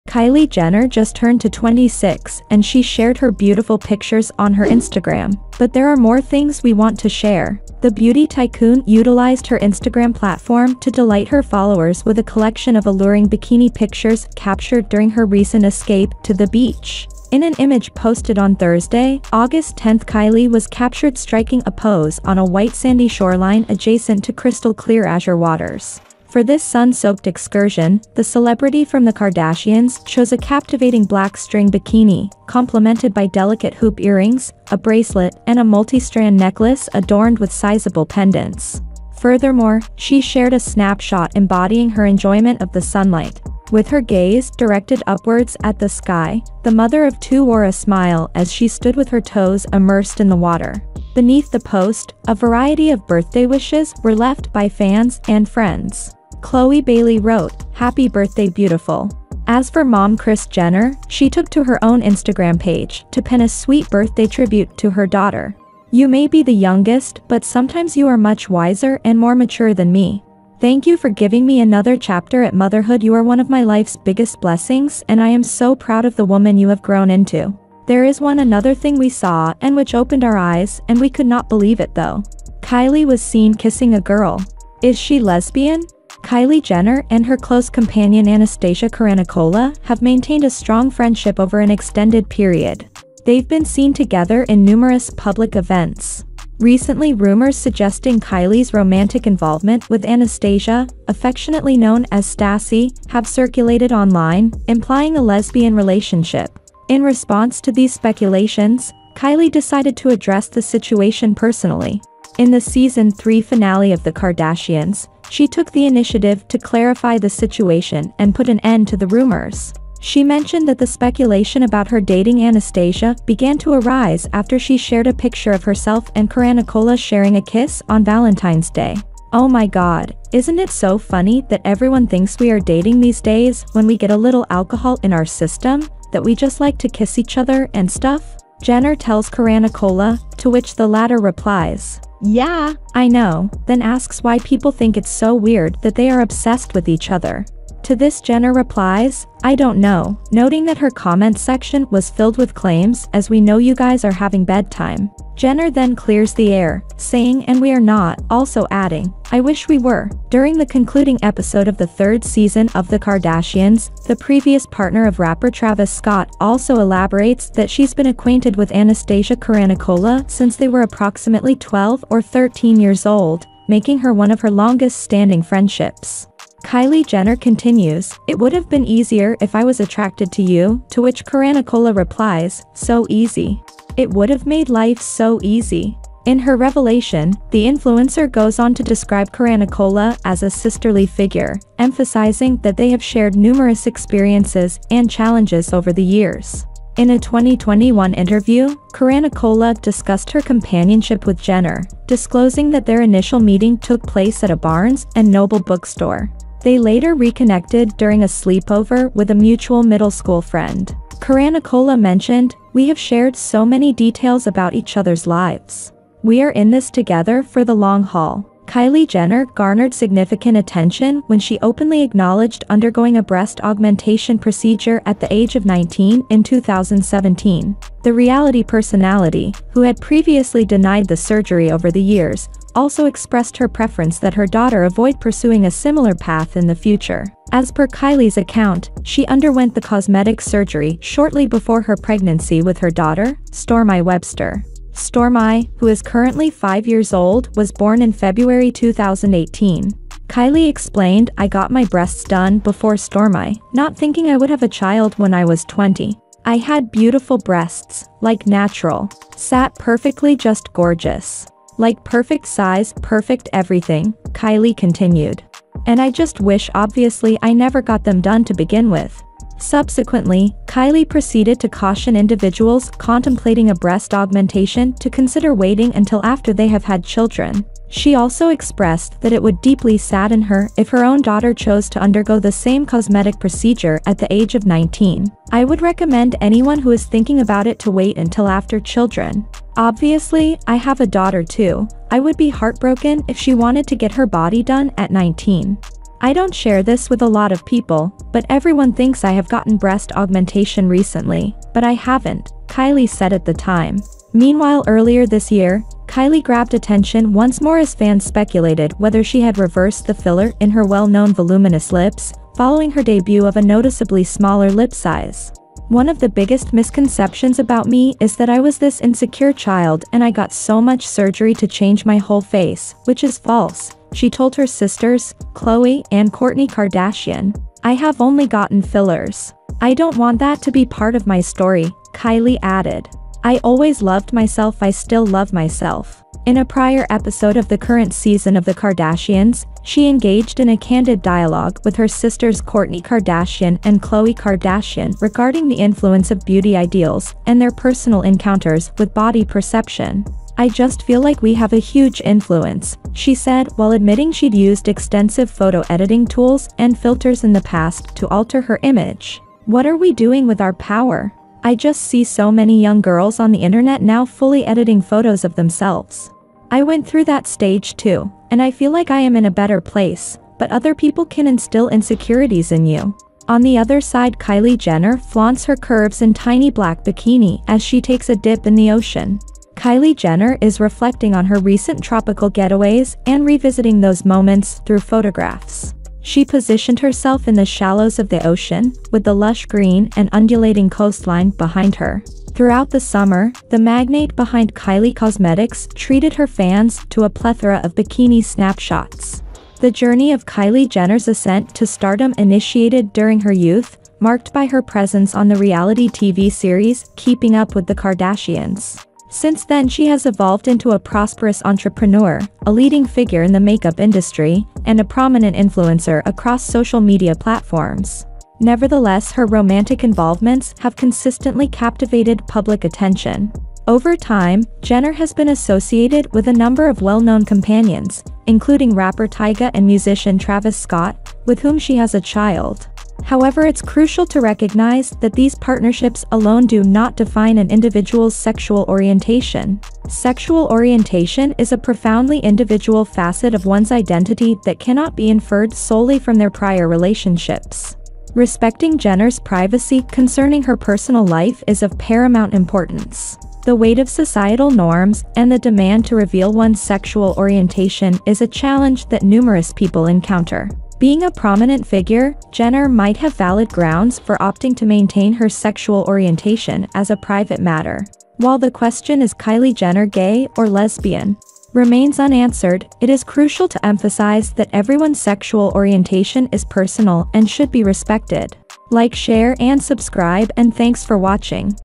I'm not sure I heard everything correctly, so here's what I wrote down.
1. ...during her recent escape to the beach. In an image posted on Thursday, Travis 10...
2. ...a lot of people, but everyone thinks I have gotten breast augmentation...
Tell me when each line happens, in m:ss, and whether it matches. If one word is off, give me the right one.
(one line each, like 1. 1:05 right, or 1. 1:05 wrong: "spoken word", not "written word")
1. 0:14 wrong: "August", not "Travis"
2. 4:57 right.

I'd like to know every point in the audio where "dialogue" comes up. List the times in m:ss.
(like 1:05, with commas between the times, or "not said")
5:41.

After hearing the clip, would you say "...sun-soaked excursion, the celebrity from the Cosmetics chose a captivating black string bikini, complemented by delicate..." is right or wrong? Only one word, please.
wrong.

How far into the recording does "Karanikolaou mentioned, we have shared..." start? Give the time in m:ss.
3:31.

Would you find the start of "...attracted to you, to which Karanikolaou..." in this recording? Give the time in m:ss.
2:59.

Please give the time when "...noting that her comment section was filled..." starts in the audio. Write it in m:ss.
2:30.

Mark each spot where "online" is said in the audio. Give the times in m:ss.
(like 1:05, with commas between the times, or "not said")
1:43.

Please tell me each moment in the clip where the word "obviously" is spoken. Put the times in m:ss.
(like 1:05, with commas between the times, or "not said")
4:26, 4:49.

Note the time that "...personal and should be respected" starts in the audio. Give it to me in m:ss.
7:56.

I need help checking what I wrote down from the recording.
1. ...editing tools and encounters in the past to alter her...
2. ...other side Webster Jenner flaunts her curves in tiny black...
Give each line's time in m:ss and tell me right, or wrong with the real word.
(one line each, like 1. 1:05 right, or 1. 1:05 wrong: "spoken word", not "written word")
1. 5:55 wrong: "filters", not "encounters"
2. 6:13 wrong: "Kylie", not "Webster".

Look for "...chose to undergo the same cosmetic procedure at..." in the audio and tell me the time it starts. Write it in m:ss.
4:41.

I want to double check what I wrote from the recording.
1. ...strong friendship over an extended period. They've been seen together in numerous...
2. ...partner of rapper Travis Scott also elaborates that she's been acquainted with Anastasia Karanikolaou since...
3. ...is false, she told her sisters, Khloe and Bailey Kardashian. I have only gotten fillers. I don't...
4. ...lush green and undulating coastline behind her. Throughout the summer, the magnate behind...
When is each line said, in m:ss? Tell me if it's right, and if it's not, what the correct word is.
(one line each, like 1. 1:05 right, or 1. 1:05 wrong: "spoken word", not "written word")
1. 1:30 right
2. 2:44 right
3. 5:23 wrong: "Kourtney", not "Bailey"
4. 6:29 right.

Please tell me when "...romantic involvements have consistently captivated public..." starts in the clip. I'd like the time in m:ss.
6:59.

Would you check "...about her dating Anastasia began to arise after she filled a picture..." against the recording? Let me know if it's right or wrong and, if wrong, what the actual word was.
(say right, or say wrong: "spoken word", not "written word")
wrong: "shared", not "filled".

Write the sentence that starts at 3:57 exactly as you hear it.
As per Kylie's account, she underwent the cosmetic surgery shortly before her pregnancy with her daughter, Stormi Webster.